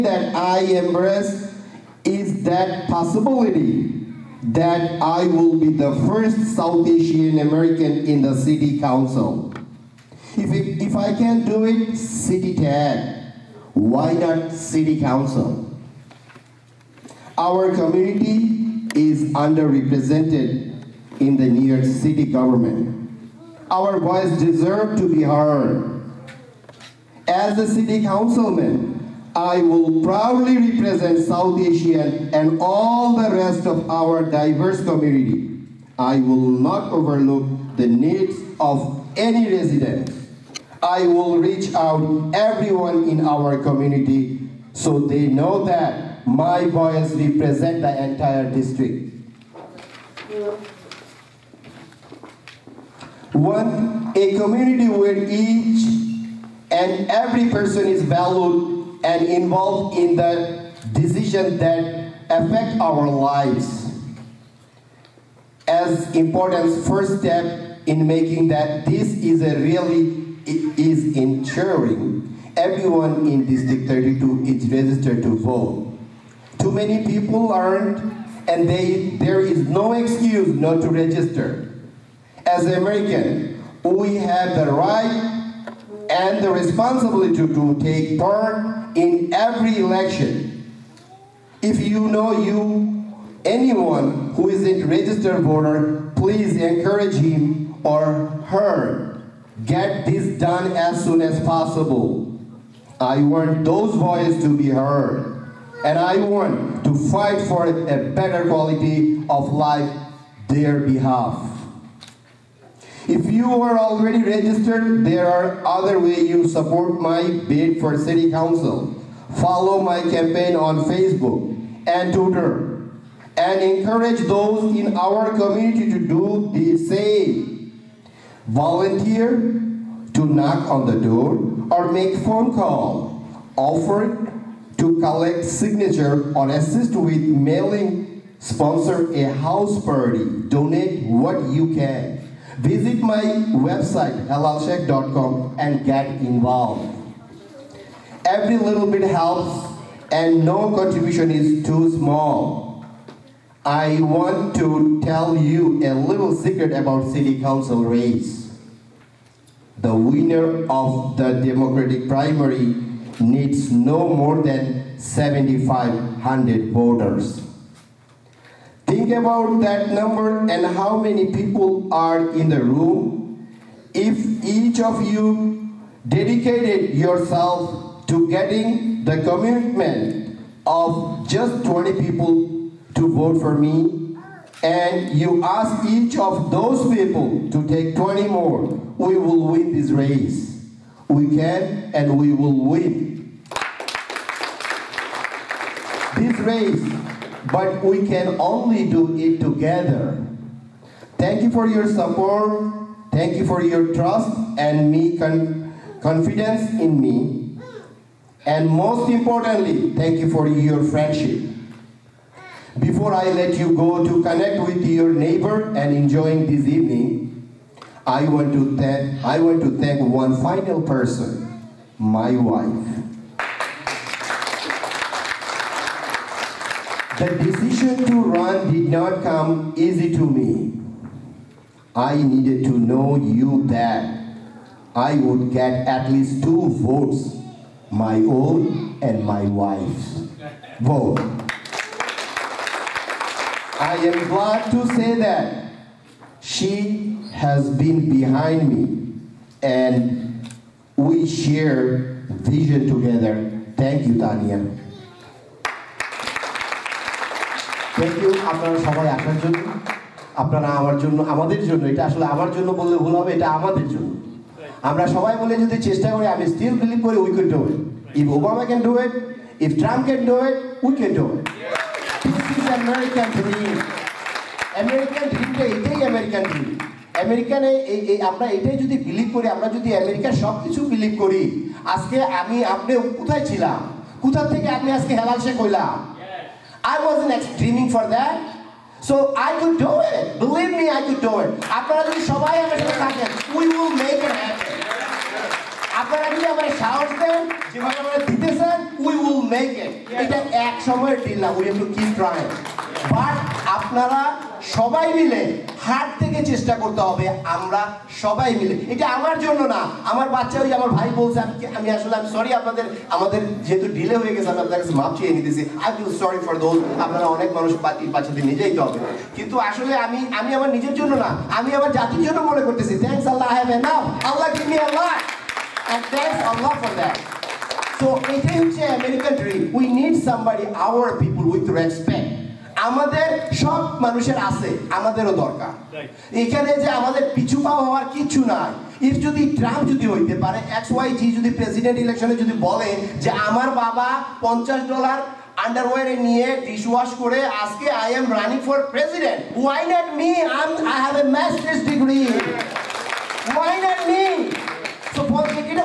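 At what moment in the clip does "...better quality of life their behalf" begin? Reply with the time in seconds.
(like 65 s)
108 s.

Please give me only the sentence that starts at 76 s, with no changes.
Too many people aren't, and they, there is no excuse not to register.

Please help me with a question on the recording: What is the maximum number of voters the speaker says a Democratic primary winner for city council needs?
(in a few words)
7,500.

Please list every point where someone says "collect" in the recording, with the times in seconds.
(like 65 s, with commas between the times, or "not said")
134 s.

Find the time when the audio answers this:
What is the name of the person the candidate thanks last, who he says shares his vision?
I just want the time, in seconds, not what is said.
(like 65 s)
254 s.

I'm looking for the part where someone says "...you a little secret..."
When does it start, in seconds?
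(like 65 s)
155 s.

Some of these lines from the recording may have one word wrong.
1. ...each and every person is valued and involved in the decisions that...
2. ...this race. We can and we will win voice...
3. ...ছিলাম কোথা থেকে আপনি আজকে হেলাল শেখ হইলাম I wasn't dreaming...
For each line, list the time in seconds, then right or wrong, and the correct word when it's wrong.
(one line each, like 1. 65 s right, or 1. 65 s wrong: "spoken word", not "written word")
1. 55 s right
2. 189 s wrong: "grace", not "voice"
3. 283 s right.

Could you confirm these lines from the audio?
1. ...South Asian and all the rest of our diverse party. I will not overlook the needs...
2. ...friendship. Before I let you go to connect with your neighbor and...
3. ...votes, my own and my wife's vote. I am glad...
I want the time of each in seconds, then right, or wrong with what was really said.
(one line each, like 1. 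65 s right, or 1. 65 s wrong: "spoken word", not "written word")
1. 31 s wrong: "community", not "party"
2. 210 s right
3. 236 s right.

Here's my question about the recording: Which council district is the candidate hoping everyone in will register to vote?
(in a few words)
District 32.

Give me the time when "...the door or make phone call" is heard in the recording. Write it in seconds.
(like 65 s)
130 s.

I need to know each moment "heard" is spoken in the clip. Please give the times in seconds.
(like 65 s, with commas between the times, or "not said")
25 s, 104 s.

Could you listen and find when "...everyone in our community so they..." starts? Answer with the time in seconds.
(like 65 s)
42 s.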